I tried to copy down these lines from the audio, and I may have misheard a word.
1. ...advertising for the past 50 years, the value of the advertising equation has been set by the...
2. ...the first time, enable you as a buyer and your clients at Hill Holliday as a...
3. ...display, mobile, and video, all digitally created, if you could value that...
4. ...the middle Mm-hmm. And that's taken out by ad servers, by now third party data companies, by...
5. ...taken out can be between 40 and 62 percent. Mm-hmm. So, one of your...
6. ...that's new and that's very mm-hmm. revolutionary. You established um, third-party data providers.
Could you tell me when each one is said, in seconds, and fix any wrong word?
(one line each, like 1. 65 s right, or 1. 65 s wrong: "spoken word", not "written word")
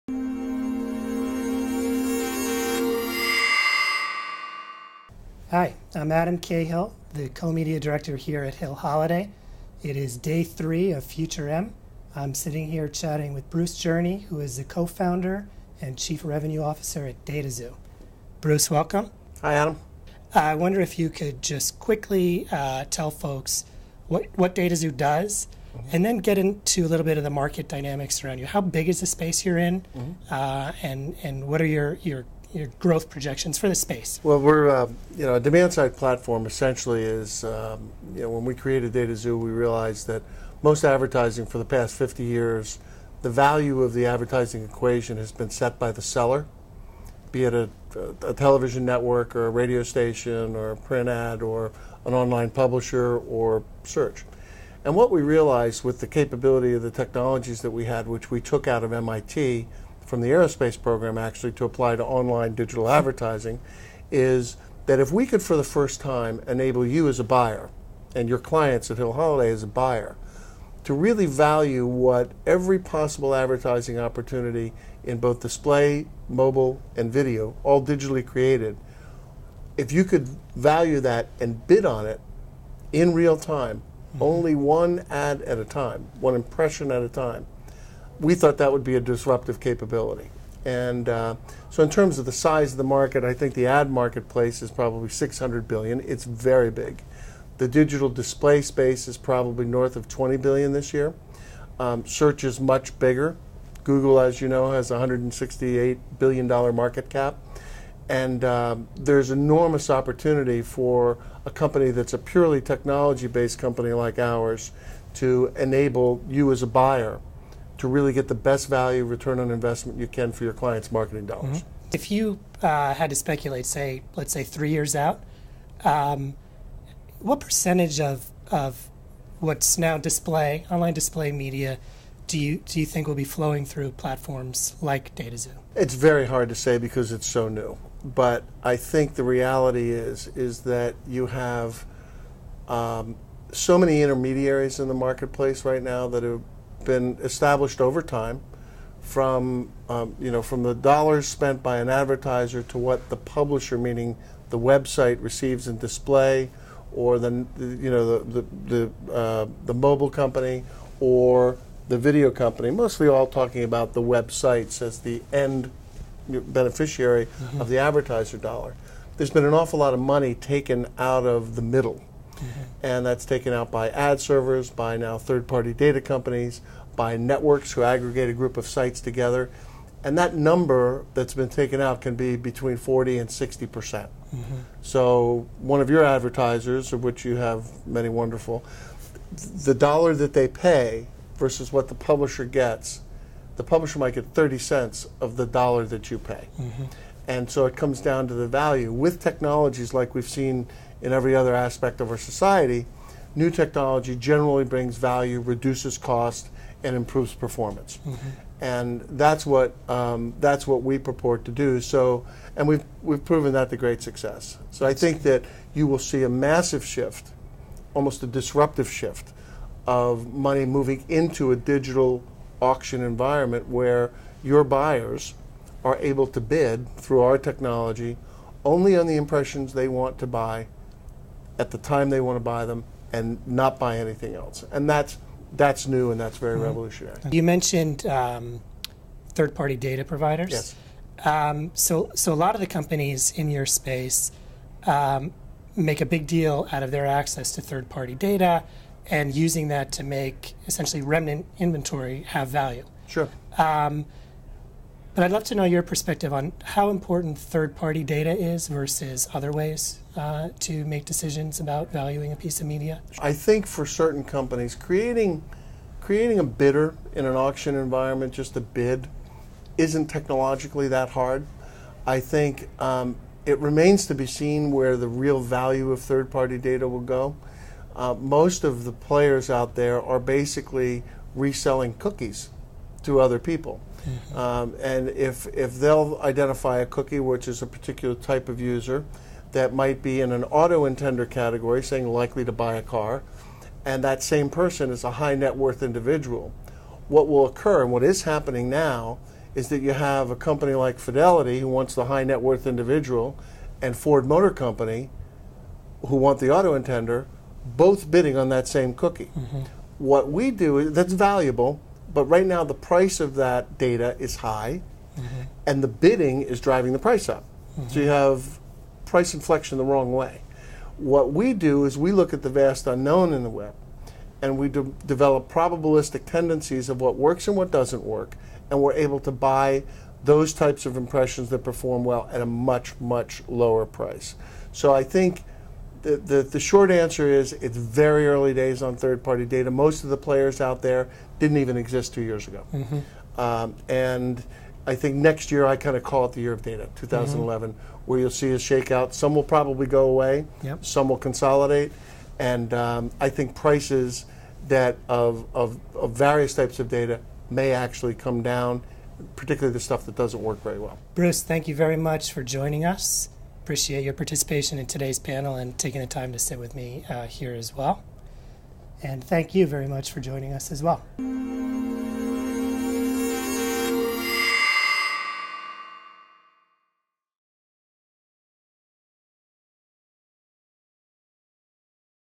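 1. 40 s right
2. 65 s right
3. 75 s right
4. 171 s right
5. 181 s wrong: "60", not "62"
6. 235 s wrong: "mentioned", not "established".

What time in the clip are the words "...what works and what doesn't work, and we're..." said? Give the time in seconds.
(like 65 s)
327 s.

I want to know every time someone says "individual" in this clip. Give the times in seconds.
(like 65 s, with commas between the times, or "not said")
295 s, 302 s.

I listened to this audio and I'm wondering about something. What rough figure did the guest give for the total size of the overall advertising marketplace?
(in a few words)
600 billion.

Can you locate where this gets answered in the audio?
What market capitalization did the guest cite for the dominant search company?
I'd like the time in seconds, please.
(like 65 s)
104 s.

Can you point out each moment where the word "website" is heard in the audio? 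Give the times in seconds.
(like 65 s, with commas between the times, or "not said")
154 s, 164 s.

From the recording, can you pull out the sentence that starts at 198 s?
With technologies like we've seen in every other aspect of our society, new technology generally brings value, reduces cost, and improves performance.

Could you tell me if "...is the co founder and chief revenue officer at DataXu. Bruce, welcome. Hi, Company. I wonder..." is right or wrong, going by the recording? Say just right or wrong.
wrong.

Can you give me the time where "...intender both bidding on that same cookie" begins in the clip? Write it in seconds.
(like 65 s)
306 s.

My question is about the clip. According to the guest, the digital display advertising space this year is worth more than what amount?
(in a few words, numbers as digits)
20 billion.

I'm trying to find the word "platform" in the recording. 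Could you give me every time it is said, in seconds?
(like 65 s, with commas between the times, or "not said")
35 s, 133 s.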